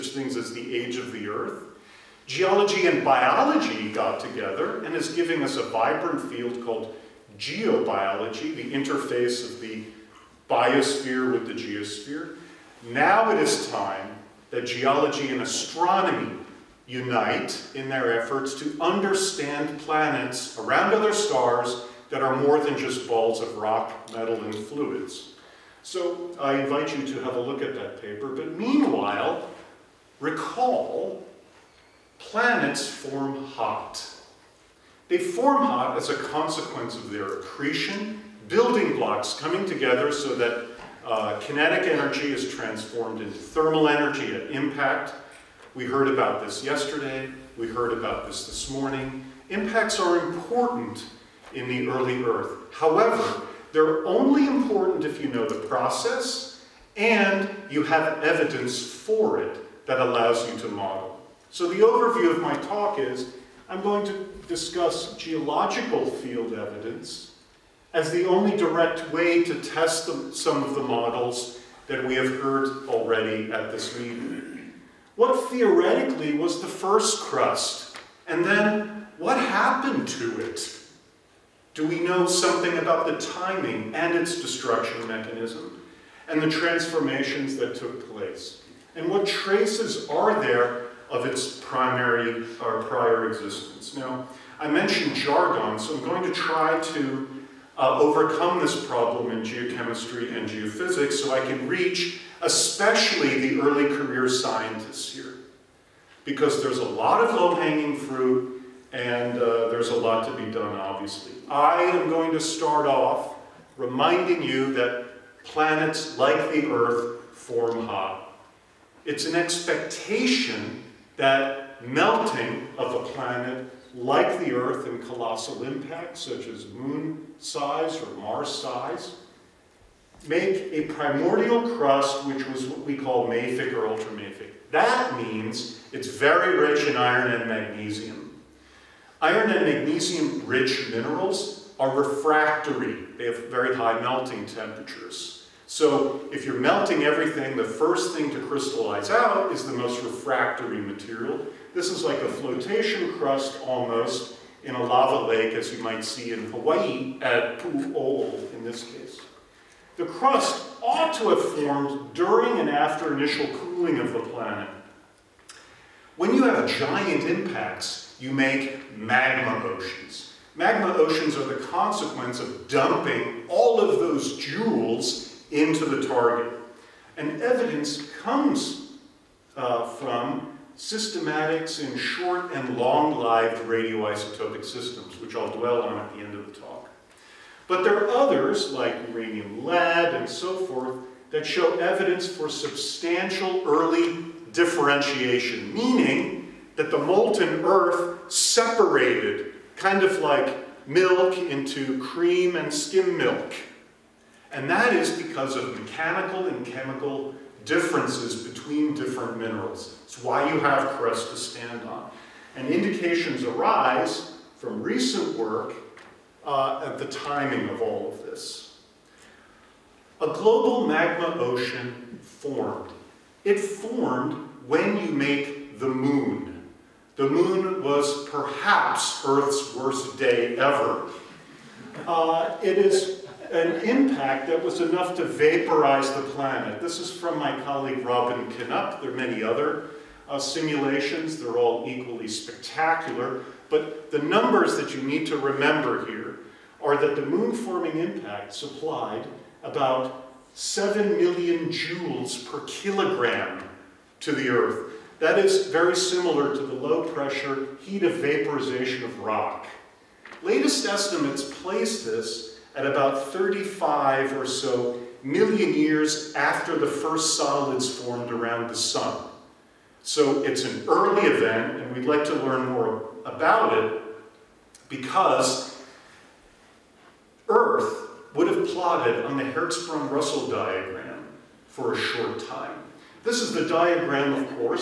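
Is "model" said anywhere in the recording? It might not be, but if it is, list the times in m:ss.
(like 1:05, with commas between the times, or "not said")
1:00, 1:10.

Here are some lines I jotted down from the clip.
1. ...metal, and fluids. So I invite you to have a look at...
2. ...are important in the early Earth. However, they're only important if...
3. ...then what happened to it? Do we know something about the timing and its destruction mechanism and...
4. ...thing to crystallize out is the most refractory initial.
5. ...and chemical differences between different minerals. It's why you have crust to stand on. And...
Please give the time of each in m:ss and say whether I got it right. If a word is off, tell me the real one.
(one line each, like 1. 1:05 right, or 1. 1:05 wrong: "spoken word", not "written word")
1. 0:24 right
2. 0:49 right
3. 1:18 right
4. 2:28 wrong: "material", not "initial"
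5. 3:26 right.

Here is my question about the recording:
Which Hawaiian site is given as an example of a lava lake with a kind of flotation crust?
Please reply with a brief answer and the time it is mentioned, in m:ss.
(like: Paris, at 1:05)
Pu'u O'o, at 2:37.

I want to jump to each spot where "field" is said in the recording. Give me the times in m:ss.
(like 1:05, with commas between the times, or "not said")
0:06, 1:06.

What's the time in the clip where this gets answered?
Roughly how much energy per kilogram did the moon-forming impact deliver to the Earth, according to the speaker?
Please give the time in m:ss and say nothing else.
4:10.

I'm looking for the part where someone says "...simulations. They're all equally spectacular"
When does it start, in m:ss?
4:00.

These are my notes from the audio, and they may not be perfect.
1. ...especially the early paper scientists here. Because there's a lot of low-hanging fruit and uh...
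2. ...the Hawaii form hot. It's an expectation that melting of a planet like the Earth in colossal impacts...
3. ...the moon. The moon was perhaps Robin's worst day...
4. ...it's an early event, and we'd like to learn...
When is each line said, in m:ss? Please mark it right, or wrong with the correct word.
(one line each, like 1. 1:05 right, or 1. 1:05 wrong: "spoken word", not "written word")
1. 1:42 wrong: "career", not "paper"
2. 1:56 wrong: "Earth", not "Hawaii"
3. 3:45 wrong: "Earth", not "Robin"
4. 4:30 right.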